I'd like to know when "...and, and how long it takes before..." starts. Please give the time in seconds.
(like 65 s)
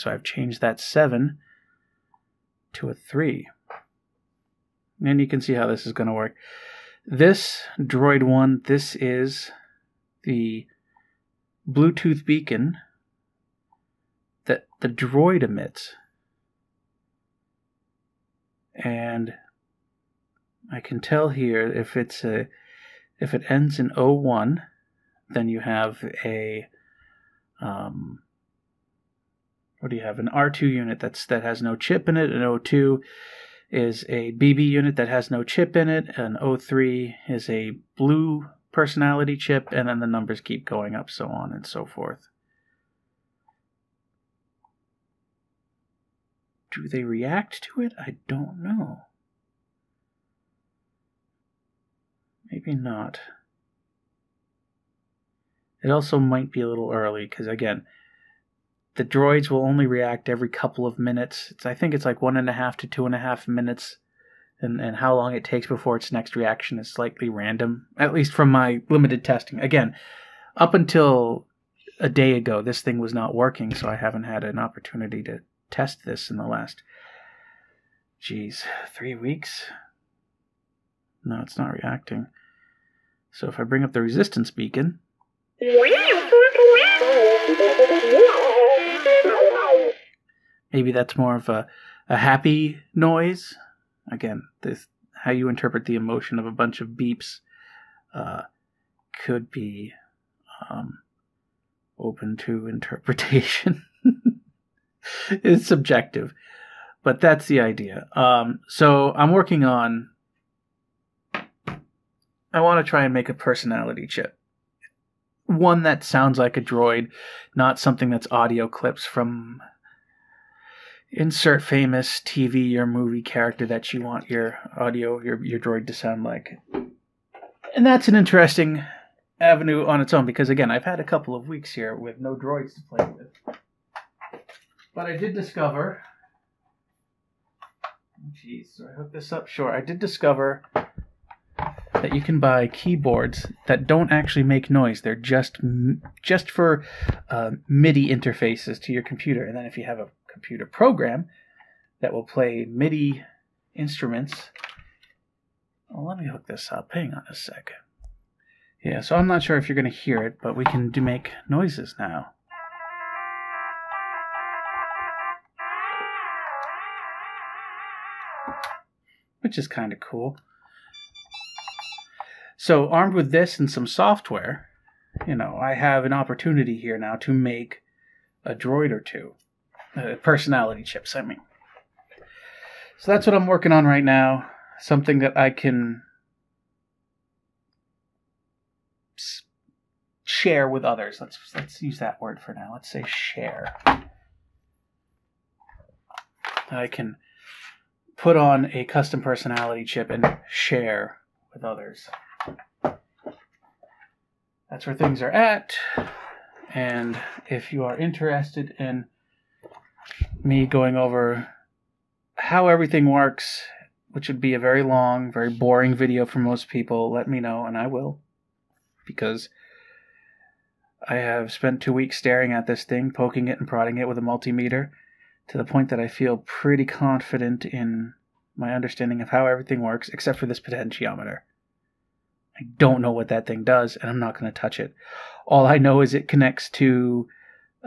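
64 s.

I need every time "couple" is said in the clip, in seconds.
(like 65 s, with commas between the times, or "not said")
60 s, 131 s.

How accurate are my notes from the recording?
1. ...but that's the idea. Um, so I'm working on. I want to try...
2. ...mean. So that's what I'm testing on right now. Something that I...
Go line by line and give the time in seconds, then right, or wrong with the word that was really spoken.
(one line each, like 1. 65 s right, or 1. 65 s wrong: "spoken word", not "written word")
1. 107 s right
2. 181 s wrong: "working", not "testing".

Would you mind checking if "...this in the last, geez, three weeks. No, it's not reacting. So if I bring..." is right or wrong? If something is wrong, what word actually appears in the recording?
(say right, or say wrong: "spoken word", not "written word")
right.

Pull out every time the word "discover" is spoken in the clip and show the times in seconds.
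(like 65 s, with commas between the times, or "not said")
135 s, 139 s.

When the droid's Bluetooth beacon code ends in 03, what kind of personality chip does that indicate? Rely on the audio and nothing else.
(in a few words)
blue personality chip.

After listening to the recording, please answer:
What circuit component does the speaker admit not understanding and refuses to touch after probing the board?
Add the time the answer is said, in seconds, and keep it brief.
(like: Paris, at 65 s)
potentiometer, at 230 s.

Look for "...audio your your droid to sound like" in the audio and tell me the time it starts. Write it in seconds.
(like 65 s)
124 s.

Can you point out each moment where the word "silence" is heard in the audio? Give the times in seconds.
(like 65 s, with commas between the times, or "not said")
not said.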